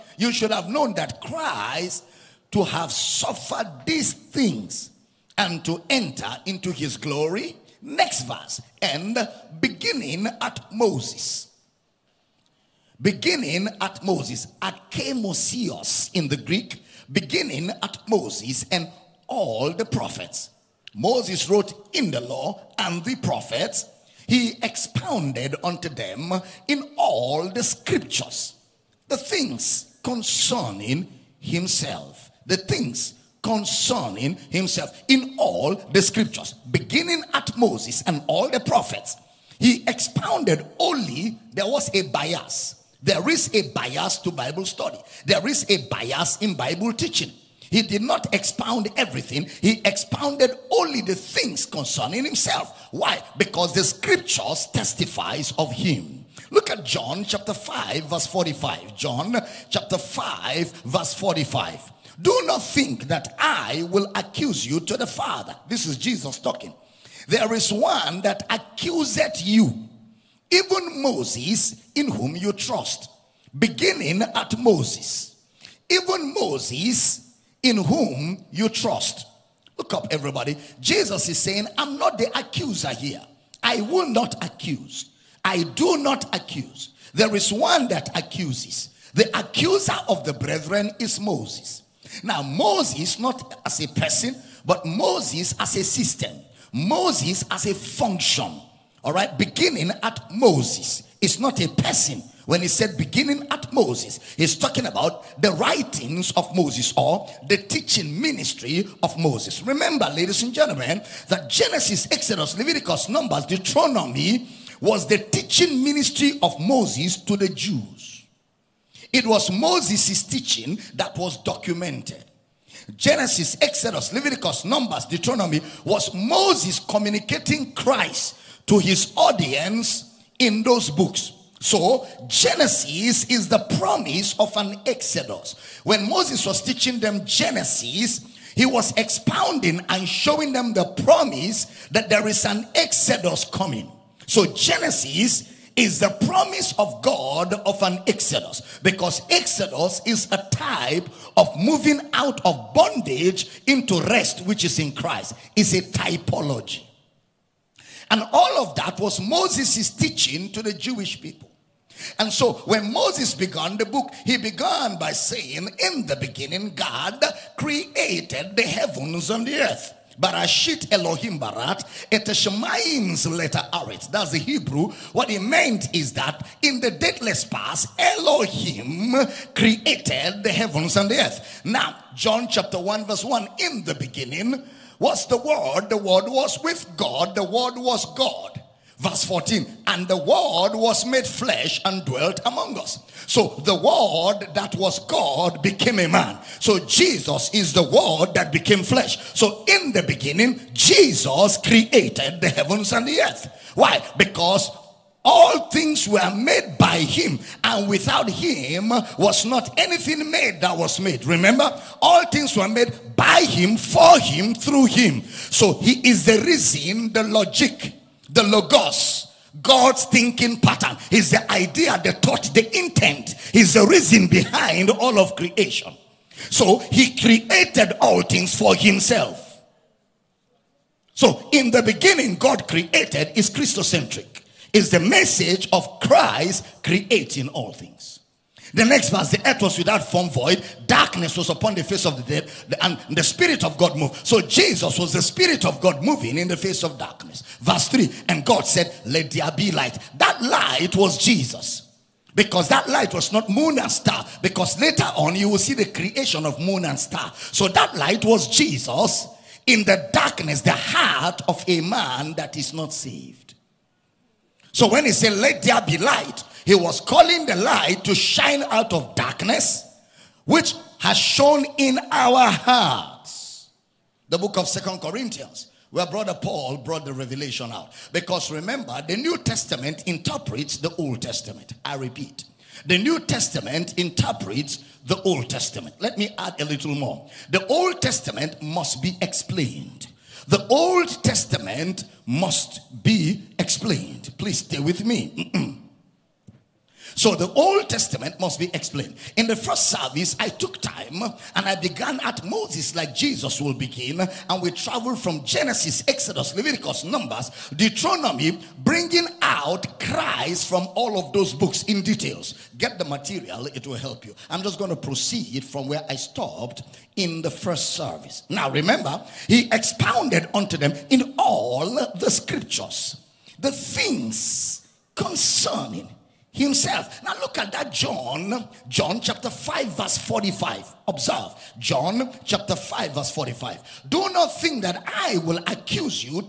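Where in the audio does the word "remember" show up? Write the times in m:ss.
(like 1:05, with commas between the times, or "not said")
1:49, 3:31, 4:38, 5:18.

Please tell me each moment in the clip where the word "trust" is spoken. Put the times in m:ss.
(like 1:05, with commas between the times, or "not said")
1:12, 1:18.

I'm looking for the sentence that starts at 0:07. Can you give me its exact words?
Next verse, and beginning at Moses.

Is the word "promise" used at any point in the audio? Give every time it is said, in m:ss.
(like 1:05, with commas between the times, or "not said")
2:13, 2:21, 2:26.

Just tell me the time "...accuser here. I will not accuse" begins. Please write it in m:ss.
1:22.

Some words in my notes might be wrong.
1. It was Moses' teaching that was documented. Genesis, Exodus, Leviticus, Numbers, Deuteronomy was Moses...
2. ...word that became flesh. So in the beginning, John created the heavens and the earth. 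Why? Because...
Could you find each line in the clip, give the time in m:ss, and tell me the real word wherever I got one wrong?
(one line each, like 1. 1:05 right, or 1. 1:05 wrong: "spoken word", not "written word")
1. 1:59 right
2. 3:17 wrong: "Jesus", not "John".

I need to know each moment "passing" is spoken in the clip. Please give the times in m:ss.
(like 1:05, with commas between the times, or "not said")
not said.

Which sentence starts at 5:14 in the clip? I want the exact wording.
I'm just going to proceed from where I stopped in the first service.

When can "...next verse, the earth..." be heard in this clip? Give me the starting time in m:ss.
3:58.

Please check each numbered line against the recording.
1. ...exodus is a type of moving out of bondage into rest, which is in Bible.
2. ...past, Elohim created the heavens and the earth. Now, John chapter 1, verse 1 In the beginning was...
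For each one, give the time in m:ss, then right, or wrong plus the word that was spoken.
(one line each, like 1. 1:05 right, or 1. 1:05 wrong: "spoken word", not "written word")
1. 2:29 wrong: "Christ", not "Bible"
2. 2:57 right.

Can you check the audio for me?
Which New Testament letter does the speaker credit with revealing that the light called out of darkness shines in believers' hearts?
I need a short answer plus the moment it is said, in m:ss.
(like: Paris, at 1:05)
Second Corinthians, at 4:34.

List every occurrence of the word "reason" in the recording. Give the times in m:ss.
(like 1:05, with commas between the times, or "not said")
3:36, 3:43.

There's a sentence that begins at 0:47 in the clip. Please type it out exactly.
He did not expound everything, he expounded only the things concerning himself.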